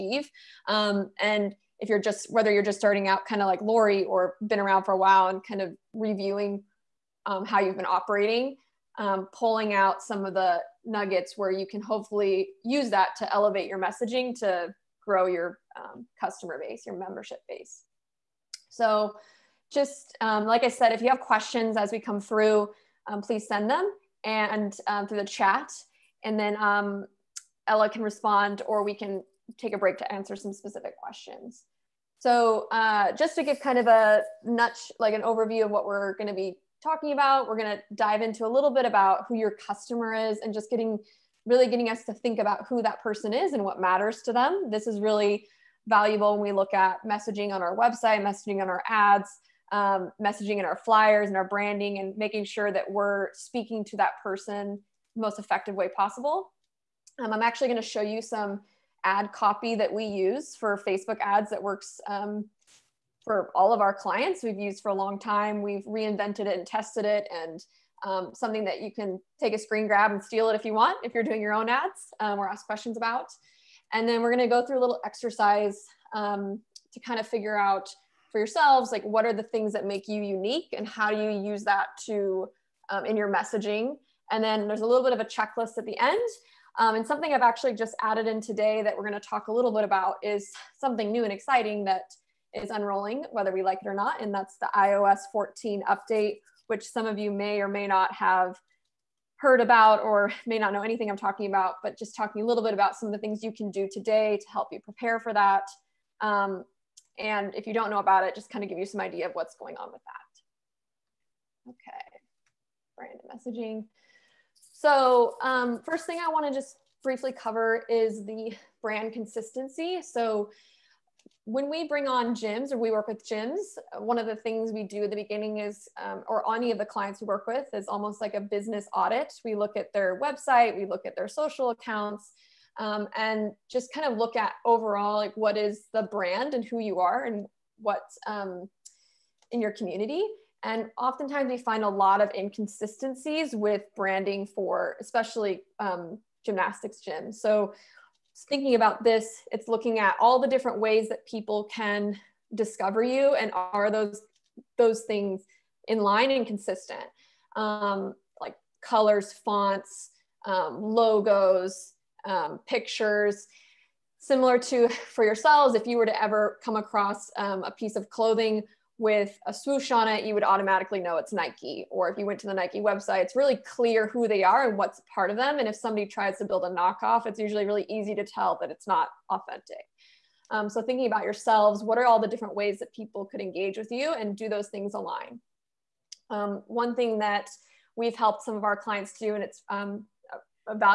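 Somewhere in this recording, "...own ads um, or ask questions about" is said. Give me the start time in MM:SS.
01:11.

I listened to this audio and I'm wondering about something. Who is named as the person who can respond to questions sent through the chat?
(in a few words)
Ella.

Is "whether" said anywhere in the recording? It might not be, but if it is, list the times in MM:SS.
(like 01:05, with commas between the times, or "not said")
00:02, 01:33.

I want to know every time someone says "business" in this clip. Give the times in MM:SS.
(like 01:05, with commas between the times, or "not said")
02:08.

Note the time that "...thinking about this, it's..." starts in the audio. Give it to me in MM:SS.
02:28.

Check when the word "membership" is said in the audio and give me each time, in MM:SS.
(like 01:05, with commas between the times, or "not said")
00:16.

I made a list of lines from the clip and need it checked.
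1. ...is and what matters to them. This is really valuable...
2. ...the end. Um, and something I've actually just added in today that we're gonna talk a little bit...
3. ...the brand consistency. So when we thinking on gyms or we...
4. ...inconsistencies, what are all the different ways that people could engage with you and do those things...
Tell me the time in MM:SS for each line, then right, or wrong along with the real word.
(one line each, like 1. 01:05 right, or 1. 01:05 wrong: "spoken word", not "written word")
1. 00:43 right
2. 01:25 right
3. 01:58 wrong: "bring", not "thinking"
4. 03:01 wrong: "yourselves", not "inconsistencies".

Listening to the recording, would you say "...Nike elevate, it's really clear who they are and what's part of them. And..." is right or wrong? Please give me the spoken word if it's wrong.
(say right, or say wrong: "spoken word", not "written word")
wrong: "website", not "elevate".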